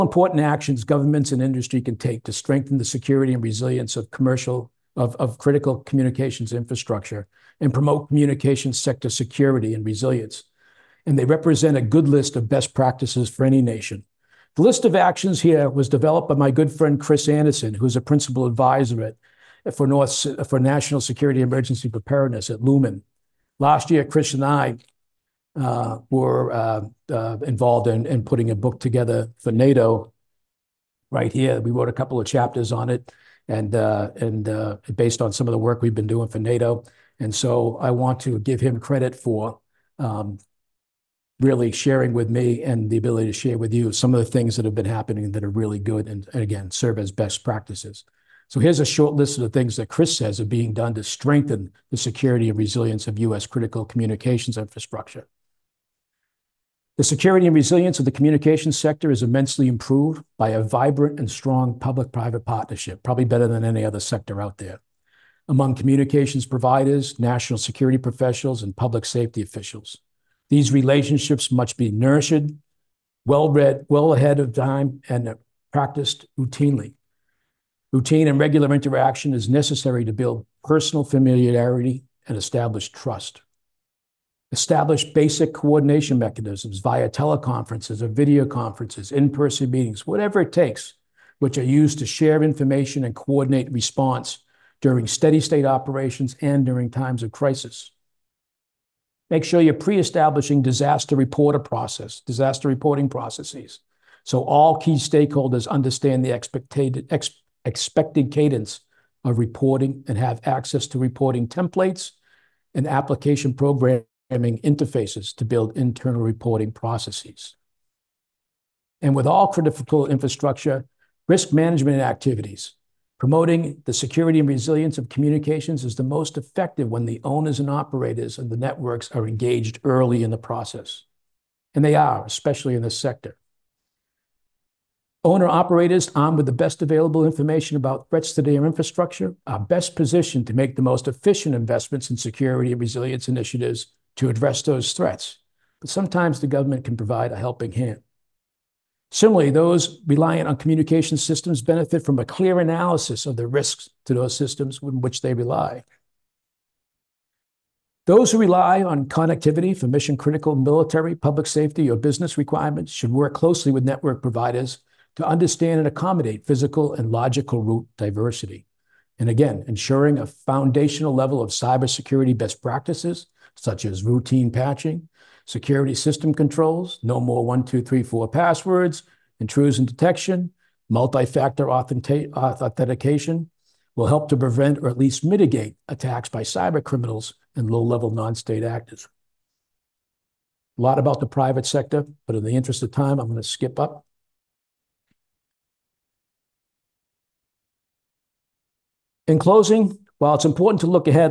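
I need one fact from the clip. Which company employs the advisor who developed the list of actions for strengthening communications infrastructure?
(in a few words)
Lumen.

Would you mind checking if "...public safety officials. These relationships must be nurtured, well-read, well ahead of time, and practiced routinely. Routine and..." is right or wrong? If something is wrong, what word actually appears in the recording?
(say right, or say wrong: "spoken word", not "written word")
right.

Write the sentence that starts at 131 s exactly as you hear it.
And they are, especially in this sector.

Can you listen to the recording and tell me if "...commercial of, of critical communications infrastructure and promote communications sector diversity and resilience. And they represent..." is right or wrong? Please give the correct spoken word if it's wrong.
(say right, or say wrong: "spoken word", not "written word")
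wrong: "security", not "diversity".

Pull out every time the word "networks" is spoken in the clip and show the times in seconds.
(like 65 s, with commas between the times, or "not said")
128 s, 163 s.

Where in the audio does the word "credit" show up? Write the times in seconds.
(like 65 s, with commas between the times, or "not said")
38 s.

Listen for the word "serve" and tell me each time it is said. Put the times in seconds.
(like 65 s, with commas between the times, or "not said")
46 s.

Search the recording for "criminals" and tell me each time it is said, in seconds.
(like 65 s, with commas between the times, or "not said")
186 s.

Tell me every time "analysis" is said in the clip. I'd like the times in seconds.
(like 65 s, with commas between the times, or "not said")
152 s.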